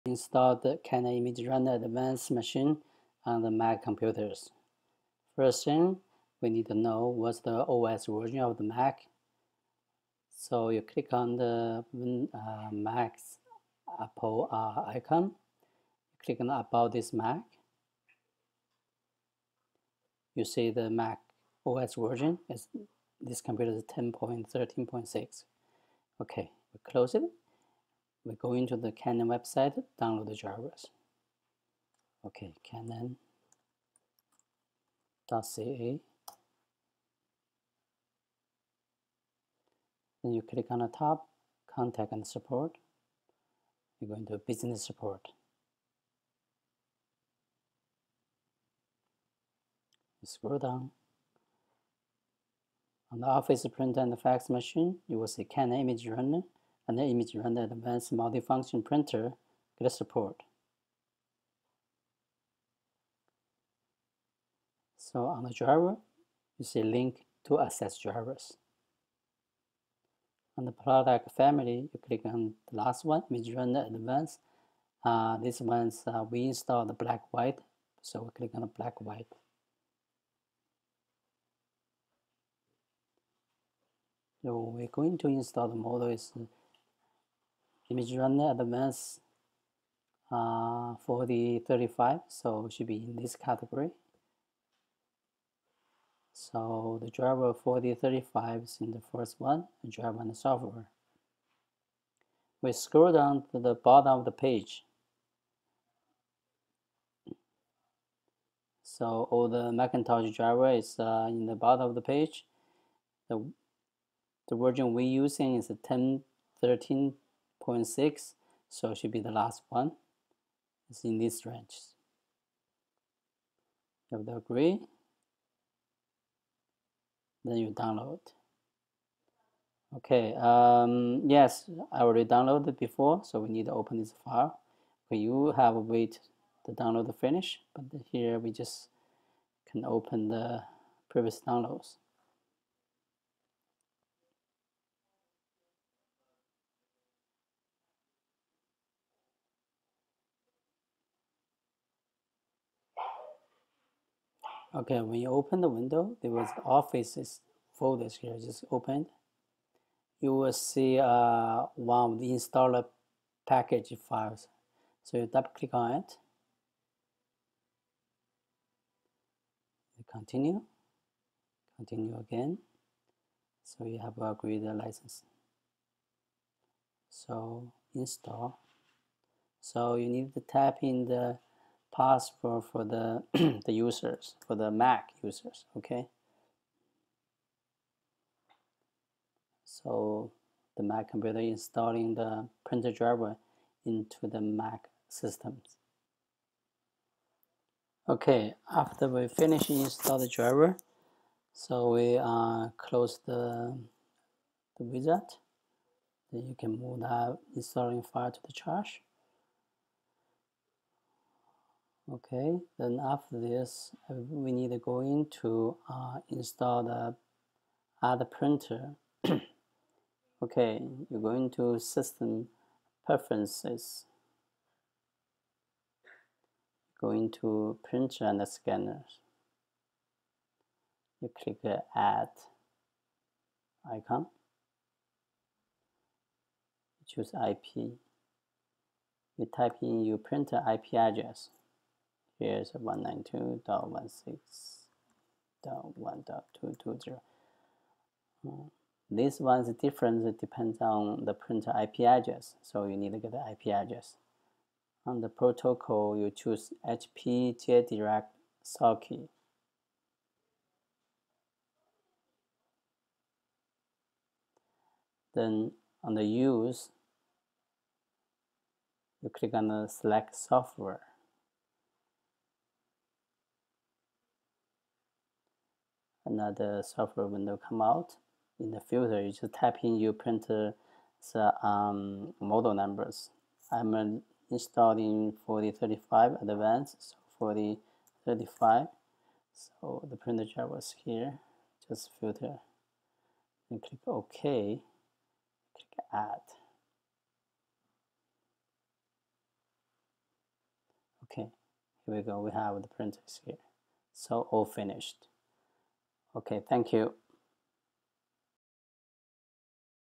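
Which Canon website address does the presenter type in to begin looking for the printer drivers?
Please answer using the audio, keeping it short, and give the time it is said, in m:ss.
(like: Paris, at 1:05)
canon.ca, at 0:32.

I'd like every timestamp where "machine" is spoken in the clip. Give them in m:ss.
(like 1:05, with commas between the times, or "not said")
0:02, 0:54.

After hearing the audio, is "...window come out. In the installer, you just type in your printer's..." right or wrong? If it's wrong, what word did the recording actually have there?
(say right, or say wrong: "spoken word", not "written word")
wrong: "filter", not "installer".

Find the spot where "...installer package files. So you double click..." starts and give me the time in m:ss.
2:42.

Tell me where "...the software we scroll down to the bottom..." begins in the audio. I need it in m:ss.
1:40.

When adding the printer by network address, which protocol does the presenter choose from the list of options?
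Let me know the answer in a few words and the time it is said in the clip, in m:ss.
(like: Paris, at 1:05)
HP JetDirect socket, at 4:16.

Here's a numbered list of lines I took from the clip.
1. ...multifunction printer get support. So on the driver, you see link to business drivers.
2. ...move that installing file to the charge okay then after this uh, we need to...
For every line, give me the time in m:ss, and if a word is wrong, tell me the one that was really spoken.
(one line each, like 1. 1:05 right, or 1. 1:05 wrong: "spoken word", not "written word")
1. 0:58 wrong: "access", not "business"
2. 3:26 right.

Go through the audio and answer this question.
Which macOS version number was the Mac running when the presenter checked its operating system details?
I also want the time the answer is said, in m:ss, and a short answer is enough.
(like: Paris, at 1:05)
10.13.6, at 0:23.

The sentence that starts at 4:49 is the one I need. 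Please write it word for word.
So the printer driver is here.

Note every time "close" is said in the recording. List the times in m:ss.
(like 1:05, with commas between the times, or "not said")
0:26, 3:22.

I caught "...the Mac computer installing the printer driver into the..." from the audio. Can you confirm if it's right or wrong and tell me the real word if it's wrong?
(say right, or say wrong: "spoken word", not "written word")
right.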